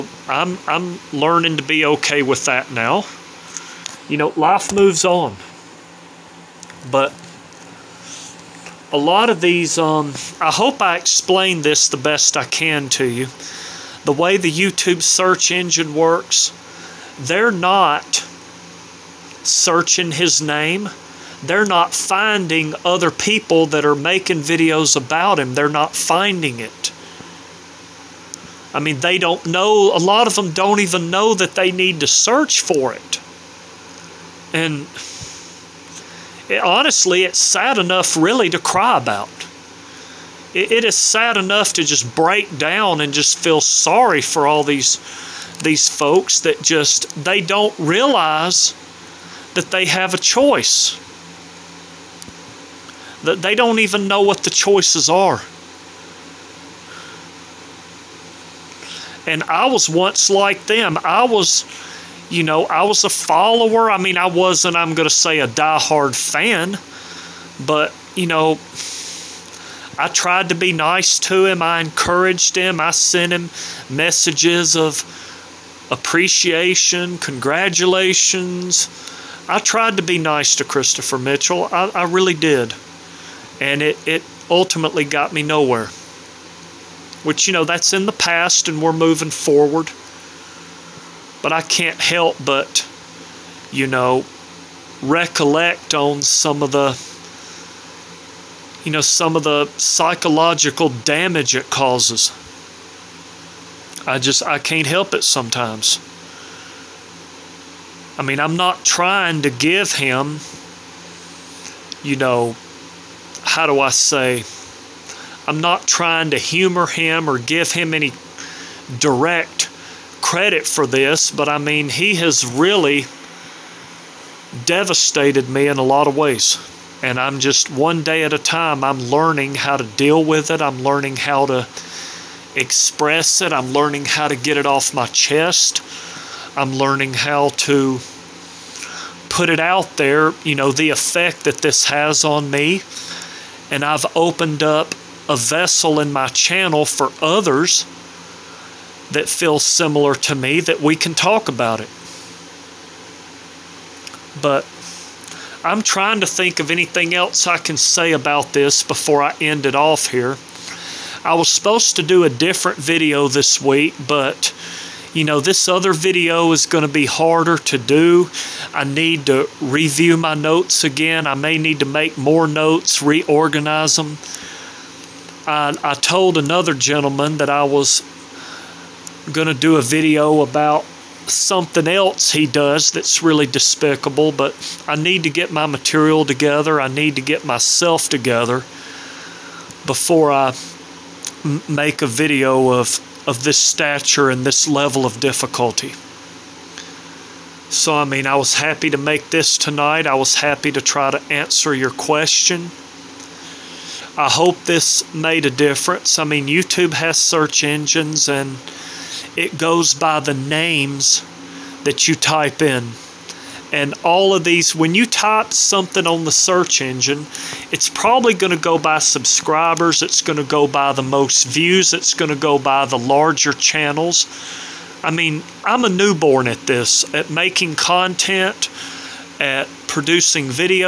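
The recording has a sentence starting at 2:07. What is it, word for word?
And I'm just one day at a time, I'm learning how to deal with it.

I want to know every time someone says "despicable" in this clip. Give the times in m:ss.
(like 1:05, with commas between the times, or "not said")
3:03.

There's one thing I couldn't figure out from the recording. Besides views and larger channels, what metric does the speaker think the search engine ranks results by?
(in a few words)
subscribers.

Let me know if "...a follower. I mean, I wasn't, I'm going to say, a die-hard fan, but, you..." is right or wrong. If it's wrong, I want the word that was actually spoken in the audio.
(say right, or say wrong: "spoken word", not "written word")
right.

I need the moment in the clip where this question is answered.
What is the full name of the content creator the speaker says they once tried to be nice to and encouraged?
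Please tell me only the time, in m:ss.
1:20.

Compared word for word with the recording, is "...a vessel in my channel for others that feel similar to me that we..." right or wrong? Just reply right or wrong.
right.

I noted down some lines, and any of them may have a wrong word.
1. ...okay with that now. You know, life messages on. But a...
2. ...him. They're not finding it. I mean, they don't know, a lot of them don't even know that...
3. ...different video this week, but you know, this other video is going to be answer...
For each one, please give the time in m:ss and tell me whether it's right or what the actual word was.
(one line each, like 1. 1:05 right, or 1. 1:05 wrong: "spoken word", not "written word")
1. 0:01 wrong: "moves", not "messages"
2. 0:25 right
3. 2:42 wrong: "harder", not "answer".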